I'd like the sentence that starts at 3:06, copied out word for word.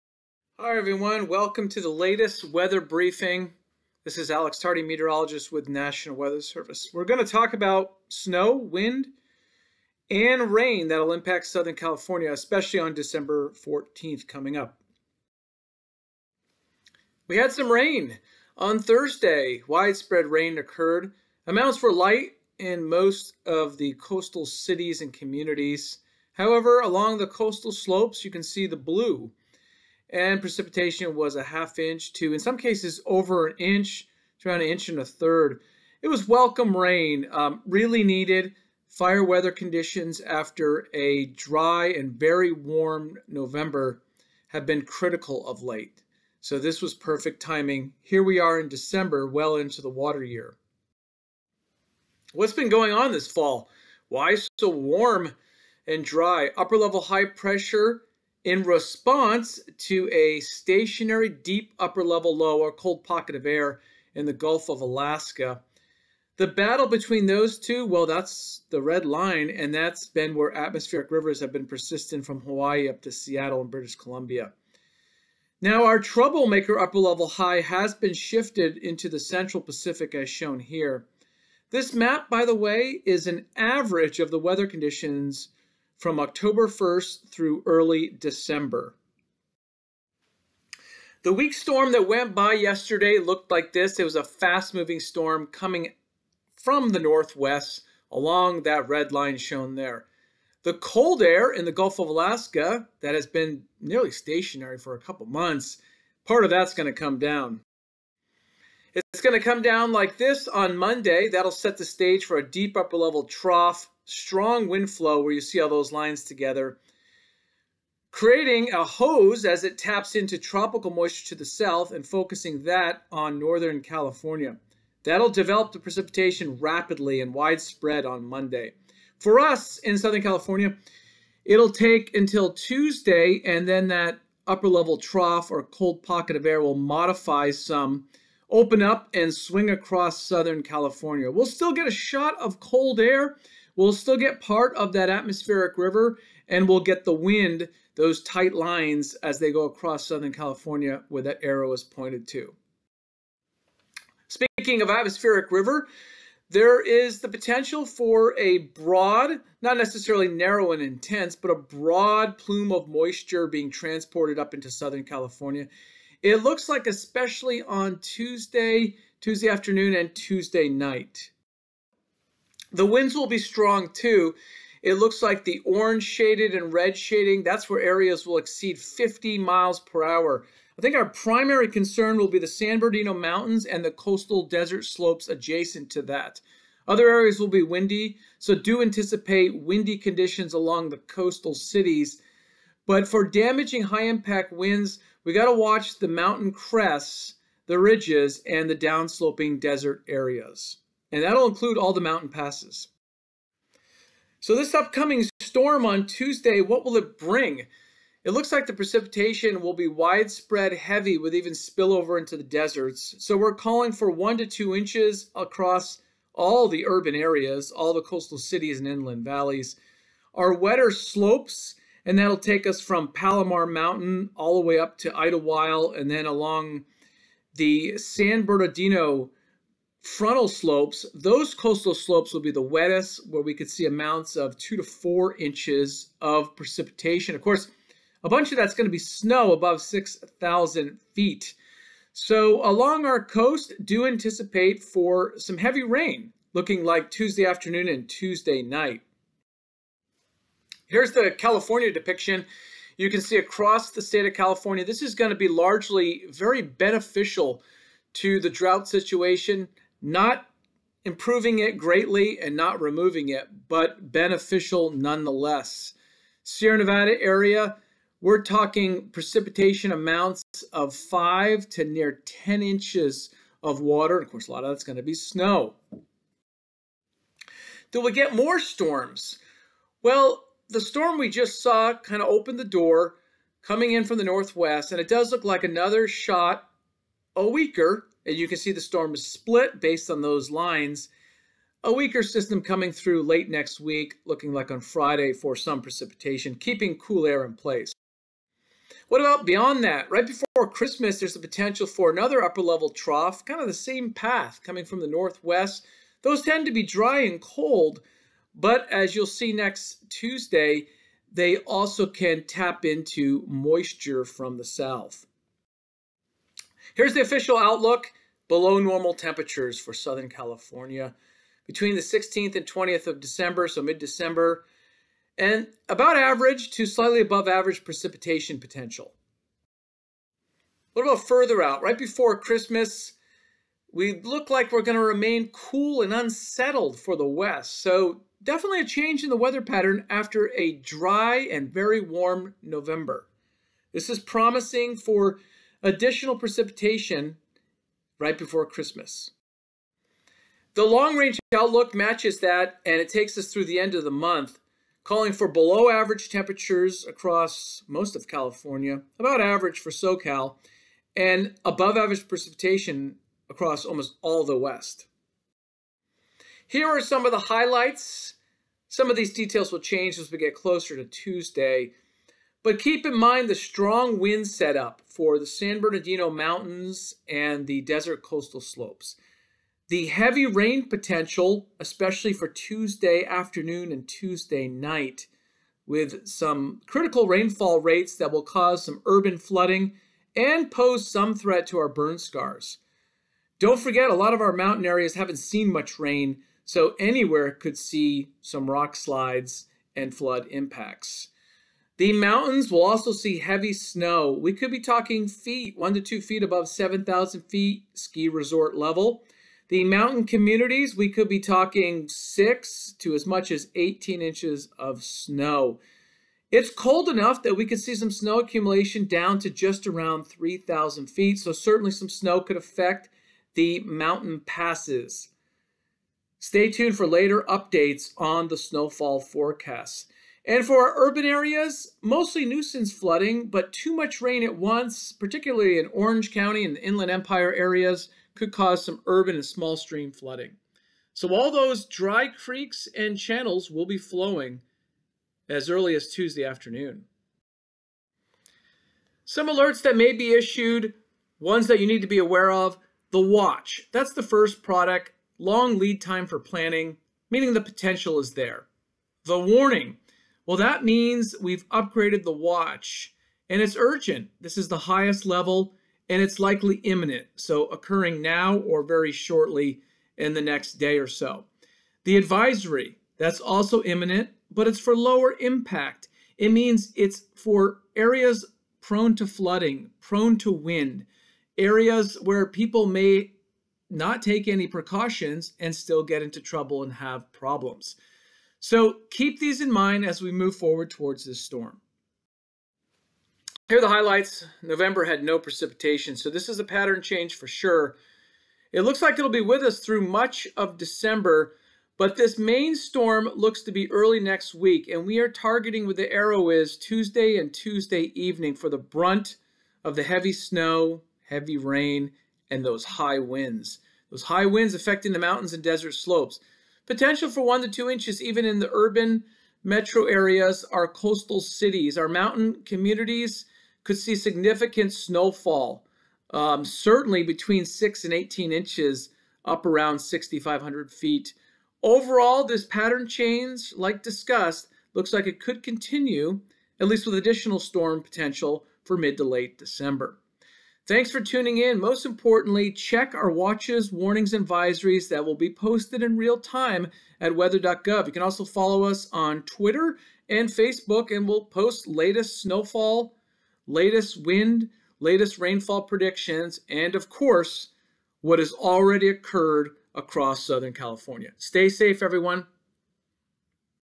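Other areas will be windy, so do anticipate windy conditions along the coastal cities.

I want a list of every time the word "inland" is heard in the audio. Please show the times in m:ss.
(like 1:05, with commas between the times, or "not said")
3:38, 7:16.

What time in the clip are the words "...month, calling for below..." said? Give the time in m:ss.
5:54.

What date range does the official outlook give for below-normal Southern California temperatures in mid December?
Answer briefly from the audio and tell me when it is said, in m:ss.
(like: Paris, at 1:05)
16th to 20th of December, at 5:21.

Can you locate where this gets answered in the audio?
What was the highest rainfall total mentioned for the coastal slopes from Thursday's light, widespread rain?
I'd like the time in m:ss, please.
0:34.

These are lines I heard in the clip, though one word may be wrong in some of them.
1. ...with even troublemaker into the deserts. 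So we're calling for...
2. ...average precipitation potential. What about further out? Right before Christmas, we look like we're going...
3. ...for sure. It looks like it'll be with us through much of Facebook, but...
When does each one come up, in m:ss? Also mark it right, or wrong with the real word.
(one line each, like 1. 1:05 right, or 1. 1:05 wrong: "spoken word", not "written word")
1. 3:31 wrong: "spillover", not "troublemaker"
2. 5:27 right
3. 8:17 wrong: "December", not "Facebook".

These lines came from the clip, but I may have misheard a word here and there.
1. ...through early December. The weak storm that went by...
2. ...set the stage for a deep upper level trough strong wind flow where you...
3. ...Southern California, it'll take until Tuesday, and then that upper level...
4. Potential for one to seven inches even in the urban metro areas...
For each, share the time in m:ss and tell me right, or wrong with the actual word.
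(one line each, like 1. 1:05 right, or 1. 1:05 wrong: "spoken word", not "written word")
1. 1:27 right
2. 1:51 right
3. 2:09 right
4. 8:36 wrong: "two", not "seven".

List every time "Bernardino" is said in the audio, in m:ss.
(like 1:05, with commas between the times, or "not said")
3:02, 3:48, 6:15.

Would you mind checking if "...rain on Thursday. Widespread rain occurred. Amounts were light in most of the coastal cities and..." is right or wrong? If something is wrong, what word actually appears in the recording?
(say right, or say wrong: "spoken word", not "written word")
right.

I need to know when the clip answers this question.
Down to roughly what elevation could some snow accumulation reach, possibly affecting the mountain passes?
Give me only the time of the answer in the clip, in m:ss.
7:00.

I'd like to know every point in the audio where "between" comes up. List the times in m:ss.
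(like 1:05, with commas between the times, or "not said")
1:06, 5:21, 8:47.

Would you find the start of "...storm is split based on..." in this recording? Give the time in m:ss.
4:48.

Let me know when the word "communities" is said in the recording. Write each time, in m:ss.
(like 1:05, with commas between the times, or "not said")
0:25, 6:50, 8:42.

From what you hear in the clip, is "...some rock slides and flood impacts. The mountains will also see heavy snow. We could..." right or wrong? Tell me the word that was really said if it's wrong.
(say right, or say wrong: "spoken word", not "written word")
right.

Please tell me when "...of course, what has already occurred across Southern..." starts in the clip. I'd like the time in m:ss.
9:16.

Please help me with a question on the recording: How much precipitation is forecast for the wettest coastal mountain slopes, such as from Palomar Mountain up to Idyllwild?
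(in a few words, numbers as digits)
2 to 4 inches.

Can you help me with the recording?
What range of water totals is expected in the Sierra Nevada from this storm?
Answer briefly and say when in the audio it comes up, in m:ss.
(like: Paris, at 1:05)
5 to near 10 inches, at 4:30.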